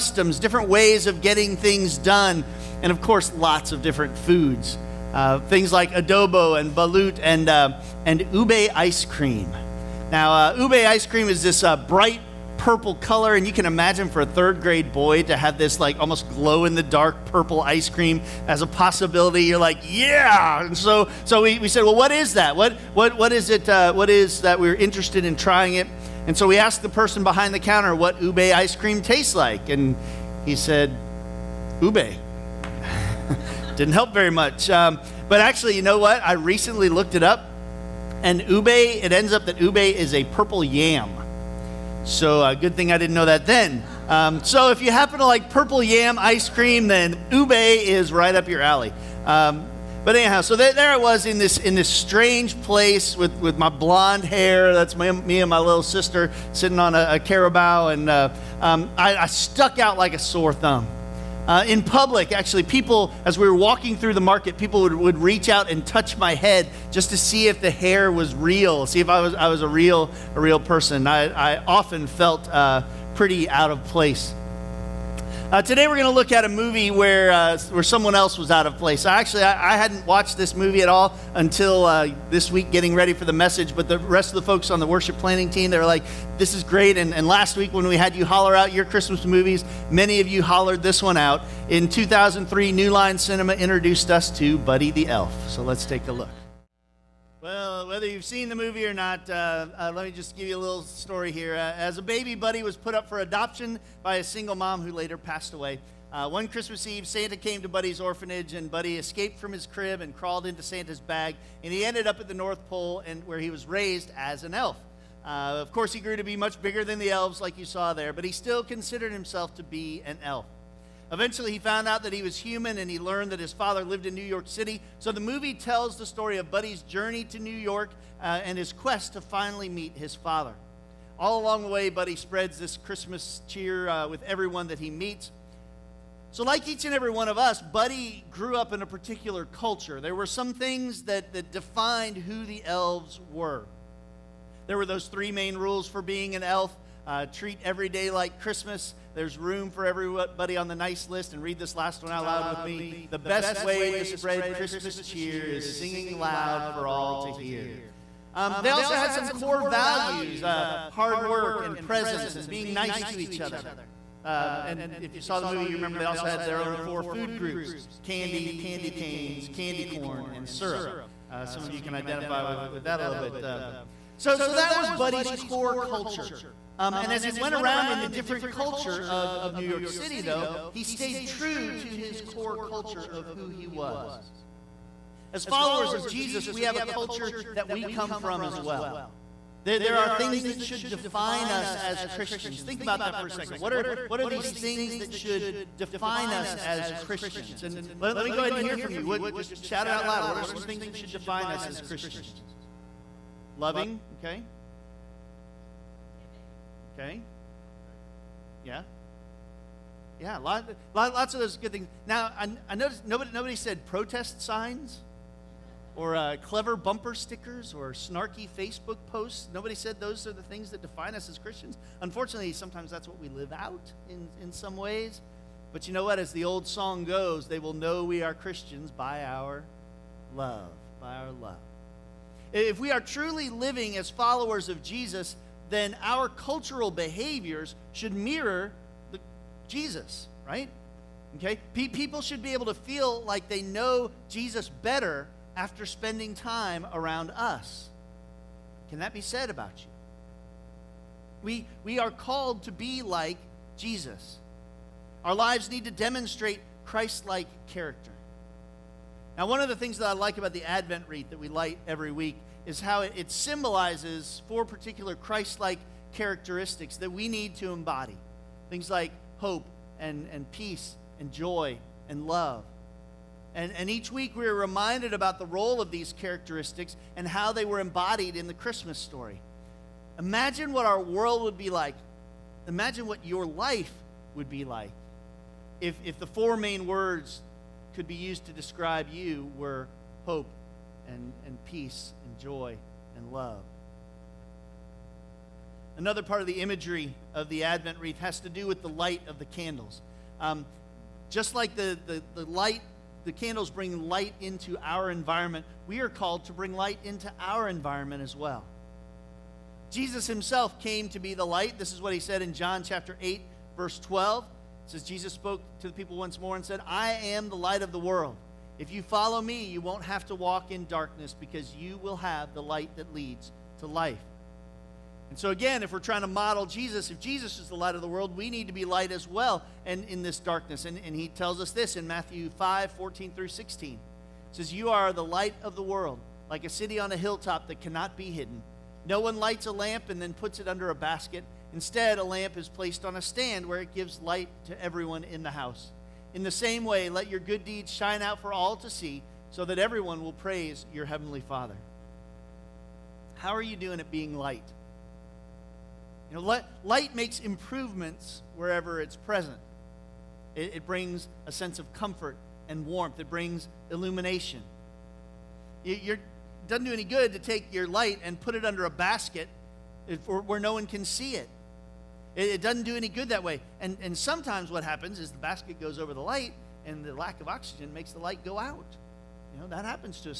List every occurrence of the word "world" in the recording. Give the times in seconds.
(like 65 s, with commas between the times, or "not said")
281 s, 317 s, 328 s, 335 s.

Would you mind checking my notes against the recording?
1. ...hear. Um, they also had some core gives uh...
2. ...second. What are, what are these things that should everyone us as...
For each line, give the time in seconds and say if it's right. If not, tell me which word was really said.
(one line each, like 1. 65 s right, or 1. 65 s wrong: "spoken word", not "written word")
1. 157 s wrong: "values", not "gives"
2. 193 s wrong: "define", not "everyone".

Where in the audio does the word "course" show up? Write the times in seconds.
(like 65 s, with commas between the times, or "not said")
3 s, 115 s.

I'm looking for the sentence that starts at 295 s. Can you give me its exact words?
Another part of the imagery of the Advent wreath has to do with the light of the candles.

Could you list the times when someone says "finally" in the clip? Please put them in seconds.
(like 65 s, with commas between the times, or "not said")
129 s.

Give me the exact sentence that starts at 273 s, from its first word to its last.
And, and each week we are reminded about the role of these characteristics and how they were embodied in the Christmas story.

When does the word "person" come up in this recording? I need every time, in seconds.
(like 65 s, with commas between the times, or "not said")
26 s, 70 s.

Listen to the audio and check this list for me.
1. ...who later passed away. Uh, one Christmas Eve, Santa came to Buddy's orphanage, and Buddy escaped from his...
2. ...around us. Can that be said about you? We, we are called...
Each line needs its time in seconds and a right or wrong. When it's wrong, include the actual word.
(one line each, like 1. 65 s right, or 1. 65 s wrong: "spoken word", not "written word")
1. 104 s right
2. 246 s right.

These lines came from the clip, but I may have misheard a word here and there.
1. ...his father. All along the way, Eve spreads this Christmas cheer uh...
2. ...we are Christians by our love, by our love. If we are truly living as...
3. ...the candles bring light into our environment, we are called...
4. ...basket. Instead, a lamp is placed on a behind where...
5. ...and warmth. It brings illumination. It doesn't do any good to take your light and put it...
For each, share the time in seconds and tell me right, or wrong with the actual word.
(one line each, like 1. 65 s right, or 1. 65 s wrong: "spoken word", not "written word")
1. 129 s wrong: "Buddy", not "Eve"
2. 228 s right
3. 303 s right
4. 340 s wrong: "stand", not "behind"
5. 362 s right.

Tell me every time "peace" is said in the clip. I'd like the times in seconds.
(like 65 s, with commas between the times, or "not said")
270 s, 291 s.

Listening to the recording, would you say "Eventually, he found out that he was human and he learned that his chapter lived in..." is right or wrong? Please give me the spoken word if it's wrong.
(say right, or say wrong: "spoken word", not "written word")
wrong: "father", not "chapter".